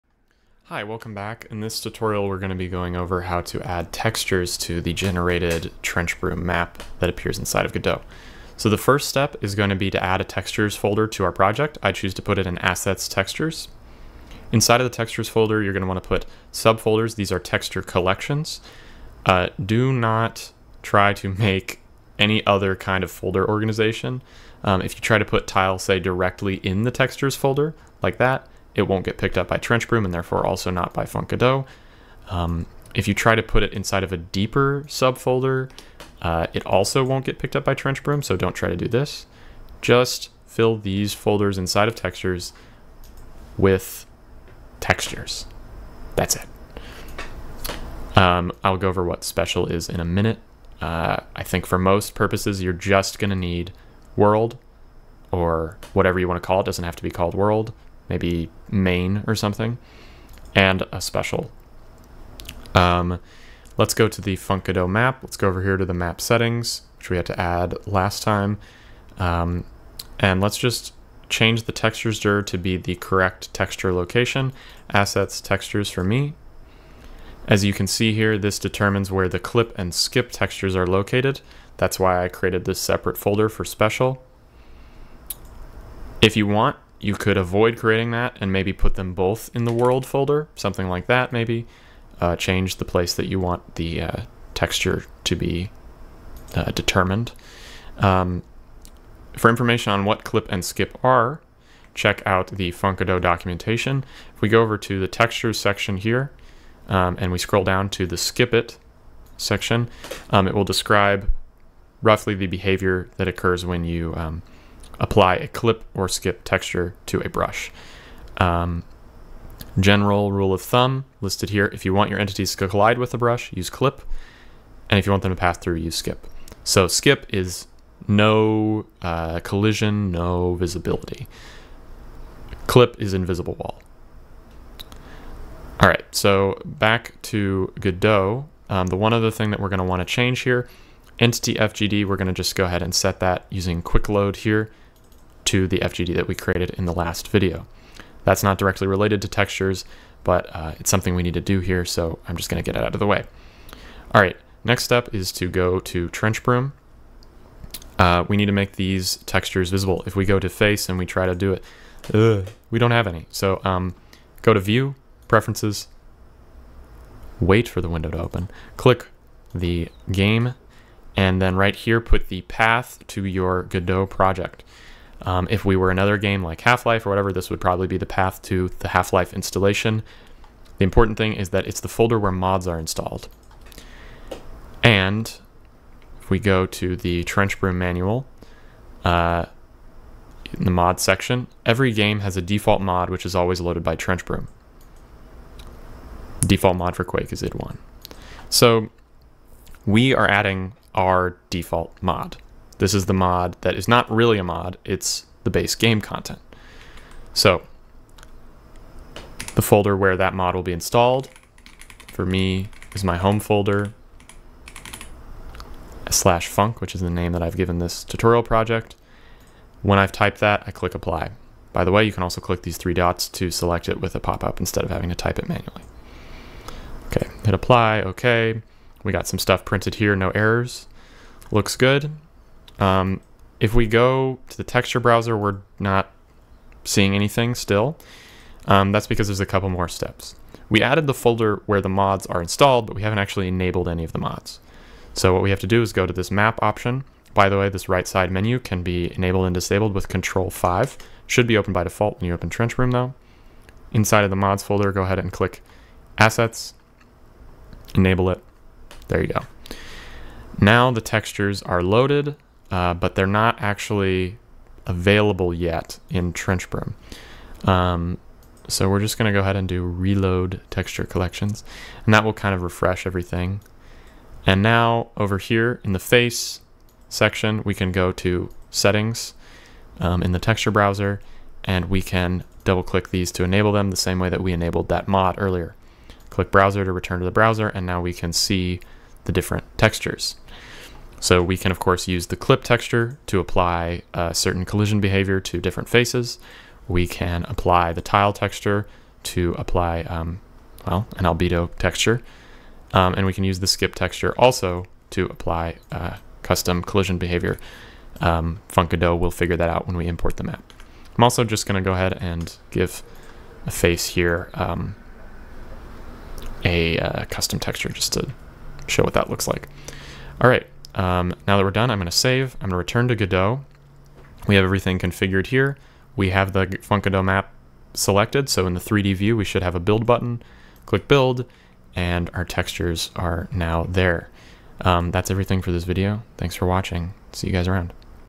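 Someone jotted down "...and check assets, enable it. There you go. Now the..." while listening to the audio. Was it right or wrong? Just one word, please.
wrong.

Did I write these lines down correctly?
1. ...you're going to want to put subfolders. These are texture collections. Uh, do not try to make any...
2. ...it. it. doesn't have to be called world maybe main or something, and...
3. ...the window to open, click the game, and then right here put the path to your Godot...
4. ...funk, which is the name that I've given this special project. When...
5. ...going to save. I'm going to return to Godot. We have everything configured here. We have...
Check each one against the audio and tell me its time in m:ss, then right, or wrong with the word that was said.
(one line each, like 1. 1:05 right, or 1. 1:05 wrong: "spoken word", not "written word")
1. 0:15 right
2. 0:56 right
3. 2:47 right
4. 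3:36 wrong: "tutorial", not "special"
5. 5:21 right.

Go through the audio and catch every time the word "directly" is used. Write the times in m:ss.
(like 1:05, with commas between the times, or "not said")
0:25, 2:28.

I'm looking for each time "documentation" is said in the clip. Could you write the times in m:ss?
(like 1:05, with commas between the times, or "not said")
1:43.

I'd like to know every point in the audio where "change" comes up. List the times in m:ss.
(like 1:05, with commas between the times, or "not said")
1:11, 1:32, 2:20.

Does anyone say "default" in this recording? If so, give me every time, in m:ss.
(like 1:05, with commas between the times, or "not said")
3:12, 3:16, 3:21, 4:11.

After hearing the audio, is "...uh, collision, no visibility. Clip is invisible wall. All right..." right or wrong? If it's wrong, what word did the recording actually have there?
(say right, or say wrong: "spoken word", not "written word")
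right.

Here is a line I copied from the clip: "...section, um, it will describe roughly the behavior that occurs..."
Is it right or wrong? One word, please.
right.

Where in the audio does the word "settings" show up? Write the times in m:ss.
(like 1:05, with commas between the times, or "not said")
1:06, 4:38.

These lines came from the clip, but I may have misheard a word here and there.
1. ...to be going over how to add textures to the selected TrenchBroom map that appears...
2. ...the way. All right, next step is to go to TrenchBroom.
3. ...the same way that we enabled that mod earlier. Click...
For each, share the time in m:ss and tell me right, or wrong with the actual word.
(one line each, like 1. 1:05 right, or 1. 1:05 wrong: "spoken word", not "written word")
1. 0:02 wrong: "generated", not "selected"
2. 2:32 right
3. 4:43 right.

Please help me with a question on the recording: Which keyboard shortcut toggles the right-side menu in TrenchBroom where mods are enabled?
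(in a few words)
Control 5.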